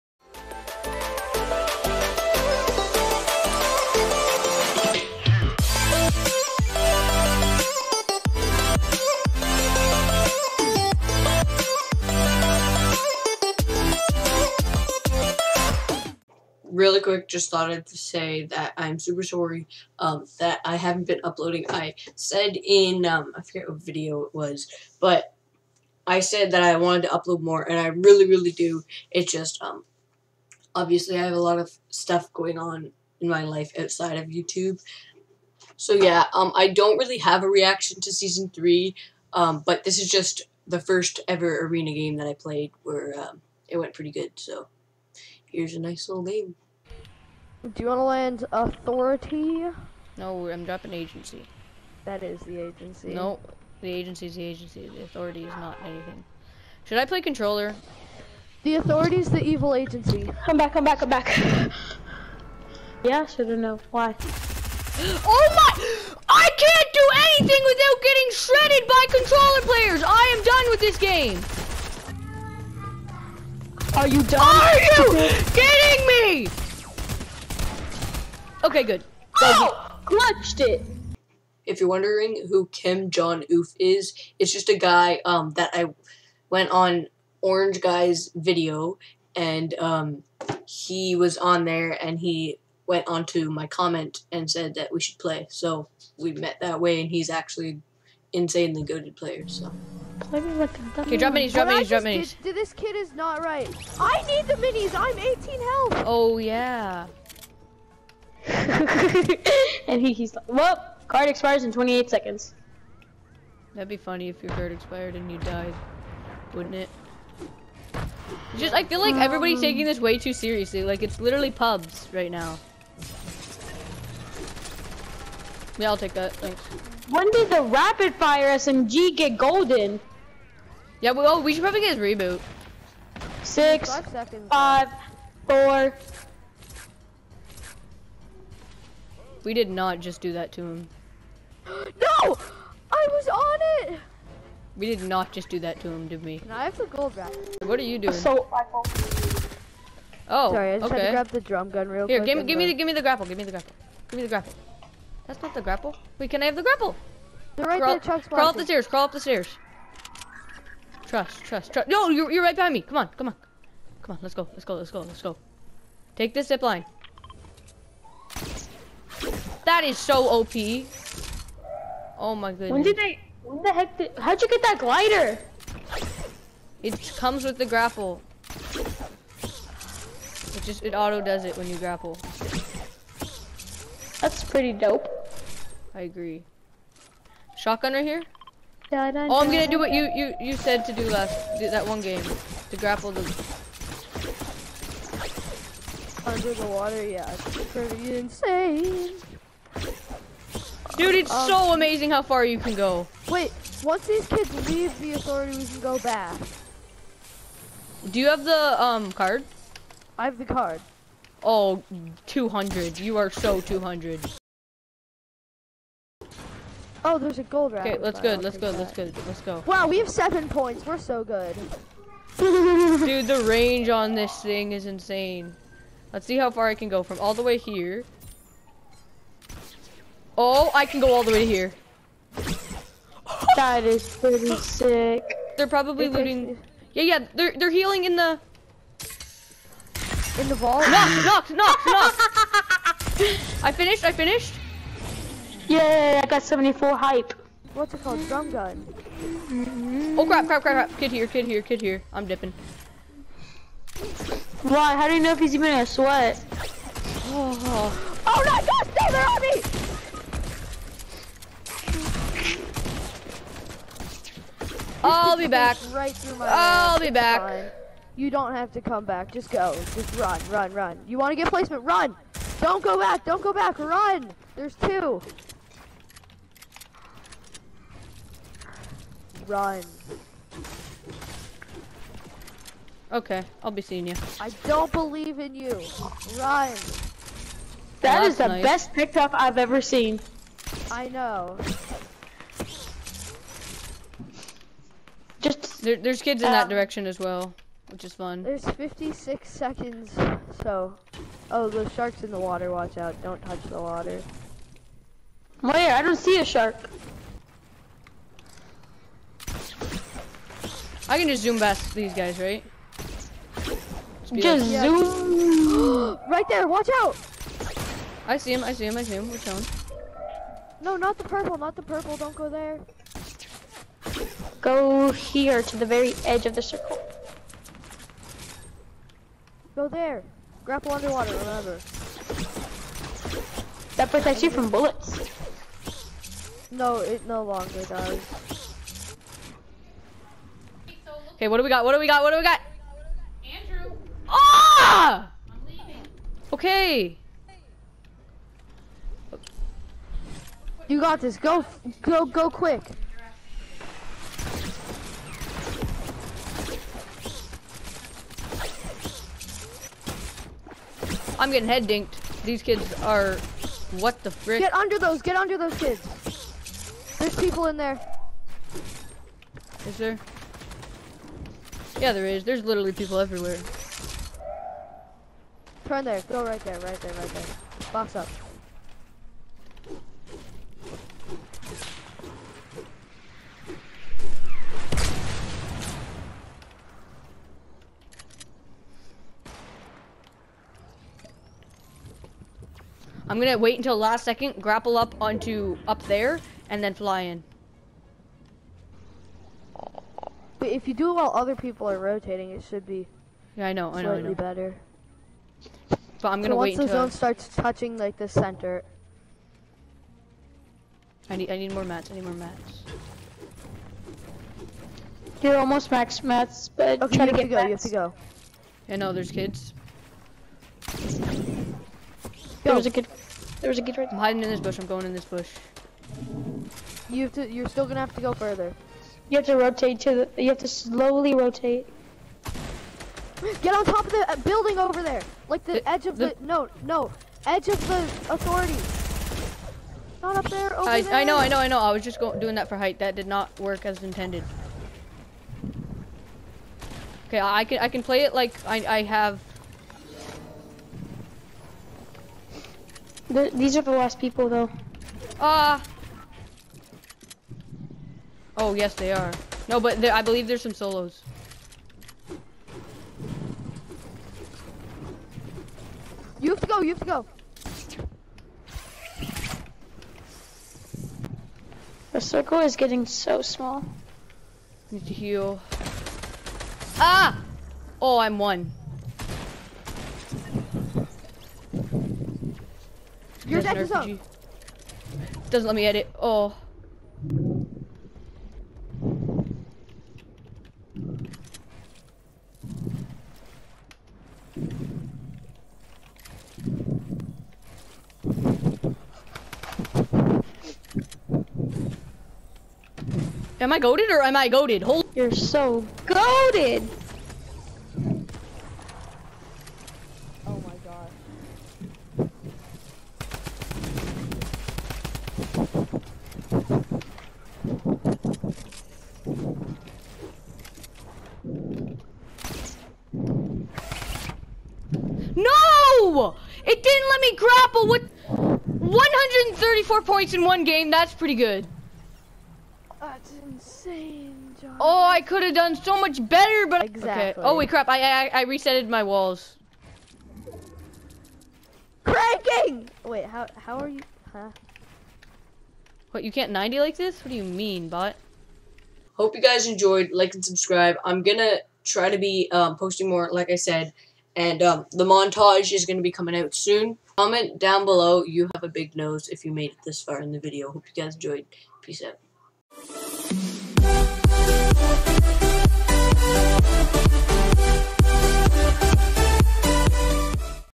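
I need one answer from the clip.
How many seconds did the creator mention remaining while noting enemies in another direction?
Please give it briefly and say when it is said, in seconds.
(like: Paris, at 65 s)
56, at 298 s.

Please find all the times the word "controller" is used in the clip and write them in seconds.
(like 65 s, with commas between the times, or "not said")
57 s, 69 s.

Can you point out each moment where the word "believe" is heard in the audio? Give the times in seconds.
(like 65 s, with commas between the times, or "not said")
284 s, 460 s.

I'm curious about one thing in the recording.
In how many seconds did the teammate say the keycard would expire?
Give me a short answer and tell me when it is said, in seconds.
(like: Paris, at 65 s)
28, at 111 s.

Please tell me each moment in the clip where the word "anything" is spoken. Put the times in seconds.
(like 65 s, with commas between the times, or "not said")
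55 s, 67 s.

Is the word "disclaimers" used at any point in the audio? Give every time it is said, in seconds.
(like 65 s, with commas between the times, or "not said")
not said.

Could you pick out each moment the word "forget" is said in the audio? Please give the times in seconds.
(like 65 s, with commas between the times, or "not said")
23 s.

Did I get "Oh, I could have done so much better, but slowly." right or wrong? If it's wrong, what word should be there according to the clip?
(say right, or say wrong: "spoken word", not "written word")
wrong: "exactly", not "slowly".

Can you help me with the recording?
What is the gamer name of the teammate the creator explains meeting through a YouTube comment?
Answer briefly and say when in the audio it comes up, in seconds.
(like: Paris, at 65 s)
Kim Jong Oof, at 82 s.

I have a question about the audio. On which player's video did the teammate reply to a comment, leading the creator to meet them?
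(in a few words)
Orange Guy.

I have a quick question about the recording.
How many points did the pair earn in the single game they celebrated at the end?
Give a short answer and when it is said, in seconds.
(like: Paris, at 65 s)
134, at 528 s.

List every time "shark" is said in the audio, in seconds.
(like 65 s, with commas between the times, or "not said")
301 s, 306 s.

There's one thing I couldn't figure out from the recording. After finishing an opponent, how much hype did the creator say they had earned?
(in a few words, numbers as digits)
74.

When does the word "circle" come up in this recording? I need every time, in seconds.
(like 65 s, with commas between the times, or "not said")
326 s, 472 s.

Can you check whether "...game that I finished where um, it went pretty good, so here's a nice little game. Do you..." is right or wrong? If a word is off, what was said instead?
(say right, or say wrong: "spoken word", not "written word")
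wrong: "played", not "finished".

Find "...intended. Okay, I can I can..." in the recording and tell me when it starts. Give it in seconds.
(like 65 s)
444 s.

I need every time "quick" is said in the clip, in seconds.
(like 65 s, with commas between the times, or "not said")
17 s, 152 s, 352 s.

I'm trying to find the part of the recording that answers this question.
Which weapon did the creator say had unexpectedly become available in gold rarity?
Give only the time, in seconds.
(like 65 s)
127 s.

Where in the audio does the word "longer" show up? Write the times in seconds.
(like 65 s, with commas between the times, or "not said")
337 s.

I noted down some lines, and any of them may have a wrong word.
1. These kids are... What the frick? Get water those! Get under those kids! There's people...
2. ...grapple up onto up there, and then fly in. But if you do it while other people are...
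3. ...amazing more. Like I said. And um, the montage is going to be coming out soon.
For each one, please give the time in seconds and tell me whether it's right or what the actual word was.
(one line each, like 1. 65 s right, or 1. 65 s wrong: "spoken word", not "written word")
1. 362 s wrong: "under", not "water"
2. 394 s right
3. 552 s wrong: "posting", not "amazing".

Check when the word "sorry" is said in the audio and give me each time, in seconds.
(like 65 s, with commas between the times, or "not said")
19 s, 150 s.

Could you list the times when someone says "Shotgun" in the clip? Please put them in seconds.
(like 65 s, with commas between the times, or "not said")
187 s.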